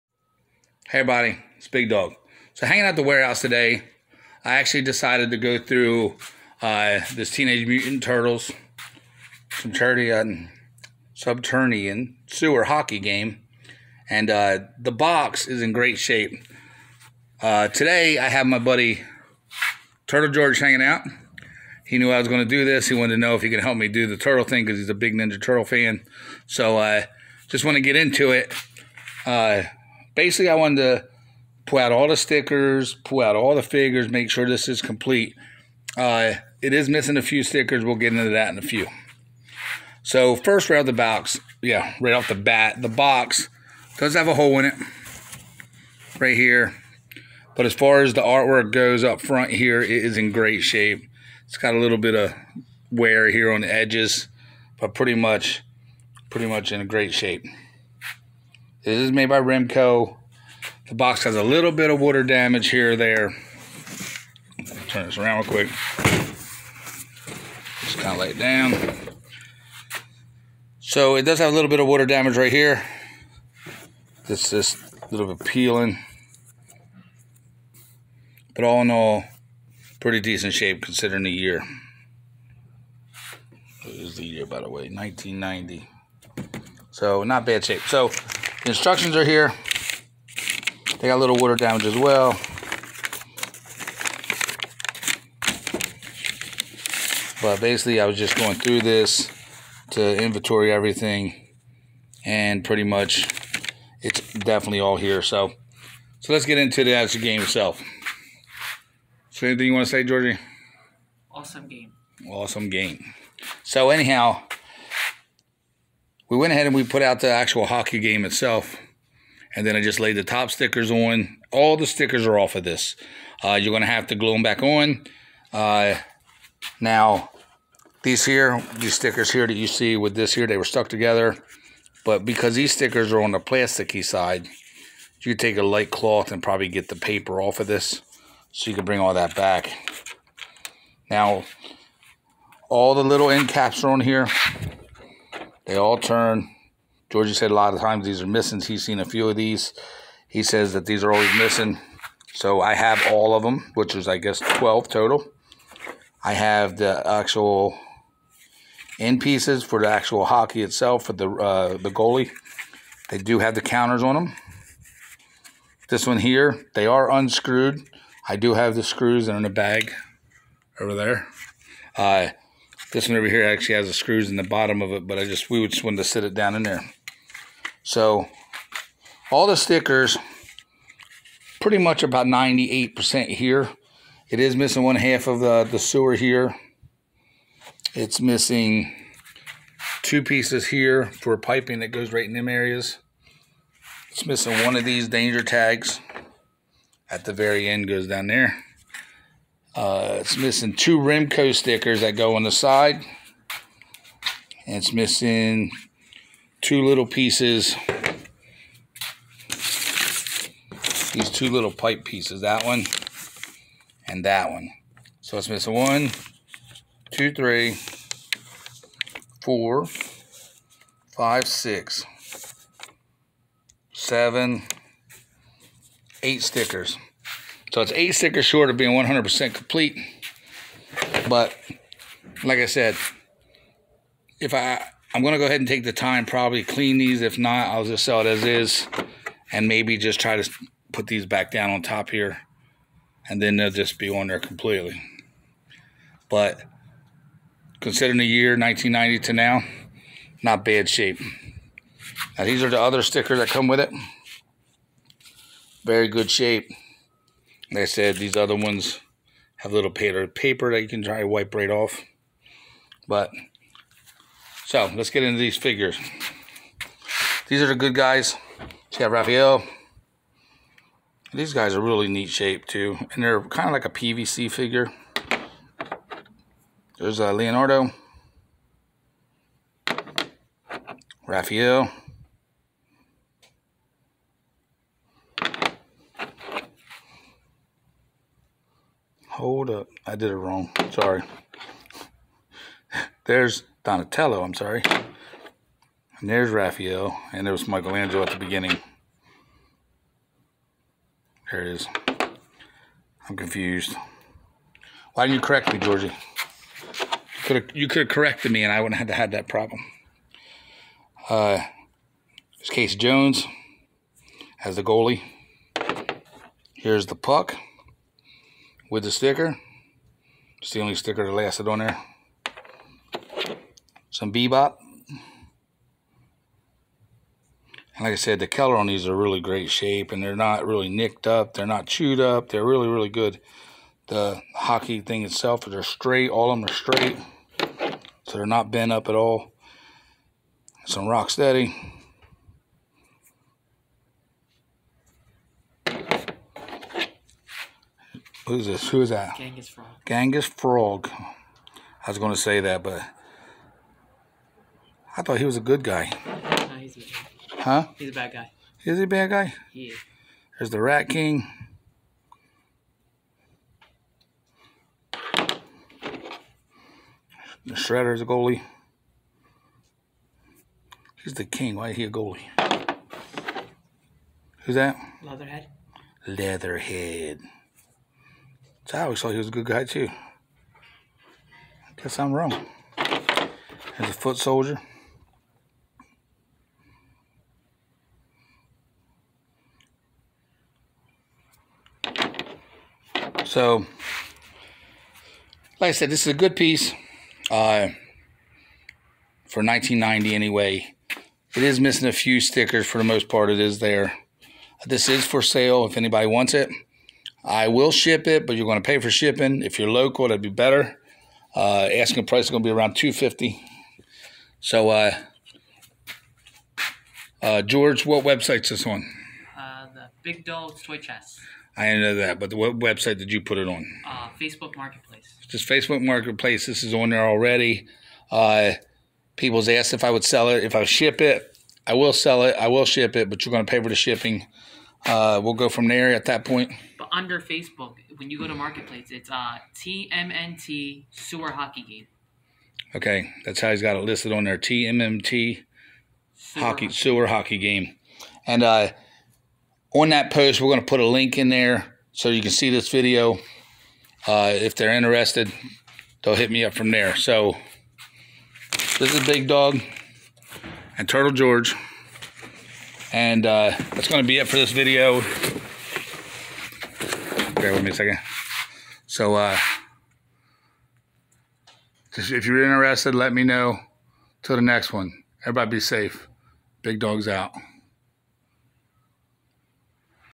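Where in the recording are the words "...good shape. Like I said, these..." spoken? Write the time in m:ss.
4:16.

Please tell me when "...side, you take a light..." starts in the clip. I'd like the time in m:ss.
2:14.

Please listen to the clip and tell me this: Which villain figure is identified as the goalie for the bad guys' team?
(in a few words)
Shredder.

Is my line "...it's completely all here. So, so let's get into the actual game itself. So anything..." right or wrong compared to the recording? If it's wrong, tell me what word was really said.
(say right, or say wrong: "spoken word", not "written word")
wrong: "definitely", not "completely".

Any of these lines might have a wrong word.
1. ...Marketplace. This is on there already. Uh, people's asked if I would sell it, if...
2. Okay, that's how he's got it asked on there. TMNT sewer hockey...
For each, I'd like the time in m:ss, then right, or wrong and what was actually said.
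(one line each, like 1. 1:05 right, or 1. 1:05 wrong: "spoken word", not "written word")
1. 7:06 right
2. 7:22 wrong: "listed", not "asked".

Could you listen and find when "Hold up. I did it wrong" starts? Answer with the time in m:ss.
4:49.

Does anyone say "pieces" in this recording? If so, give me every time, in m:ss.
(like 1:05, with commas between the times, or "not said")
2:39, 3:10, 3:27, 3:32, 6:36.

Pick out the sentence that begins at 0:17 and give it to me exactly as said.
Uh, today I have my buddy Turtle George hanging out.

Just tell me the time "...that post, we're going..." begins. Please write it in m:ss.
7:30.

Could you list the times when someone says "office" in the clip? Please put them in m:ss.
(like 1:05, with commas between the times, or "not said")
not said.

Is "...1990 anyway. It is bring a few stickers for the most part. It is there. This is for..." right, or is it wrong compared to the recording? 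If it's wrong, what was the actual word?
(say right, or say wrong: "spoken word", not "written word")
wrong: "missing", not "bring".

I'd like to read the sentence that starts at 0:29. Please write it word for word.
Uh, basically, I wanted to pull out all the stickers, pull out all the figures, make sure this is complete.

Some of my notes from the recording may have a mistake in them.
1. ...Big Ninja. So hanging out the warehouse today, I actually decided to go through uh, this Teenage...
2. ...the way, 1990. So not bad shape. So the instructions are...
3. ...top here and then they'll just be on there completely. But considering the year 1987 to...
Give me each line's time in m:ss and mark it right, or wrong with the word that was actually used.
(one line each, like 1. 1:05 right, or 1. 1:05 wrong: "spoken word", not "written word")
1. 0:01 wrong: "Dogg", not "Ninja"
2. 1:24 right
3. 4:01 wrong: "1990", not "1987".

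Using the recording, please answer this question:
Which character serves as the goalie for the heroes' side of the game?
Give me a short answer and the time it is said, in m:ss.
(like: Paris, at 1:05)
Casey Jones, at 5:12.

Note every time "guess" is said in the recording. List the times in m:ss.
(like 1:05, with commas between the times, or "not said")
2:34, 6:22.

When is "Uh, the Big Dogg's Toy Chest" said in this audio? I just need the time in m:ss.
6:59.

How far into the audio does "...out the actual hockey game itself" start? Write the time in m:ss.
1:57.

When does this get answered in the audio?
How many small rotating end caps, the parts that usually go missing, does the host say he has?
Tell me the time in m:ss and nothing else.
2:34.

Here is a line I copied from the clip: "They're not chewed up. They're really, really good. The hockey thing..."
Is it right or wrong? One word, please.
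right.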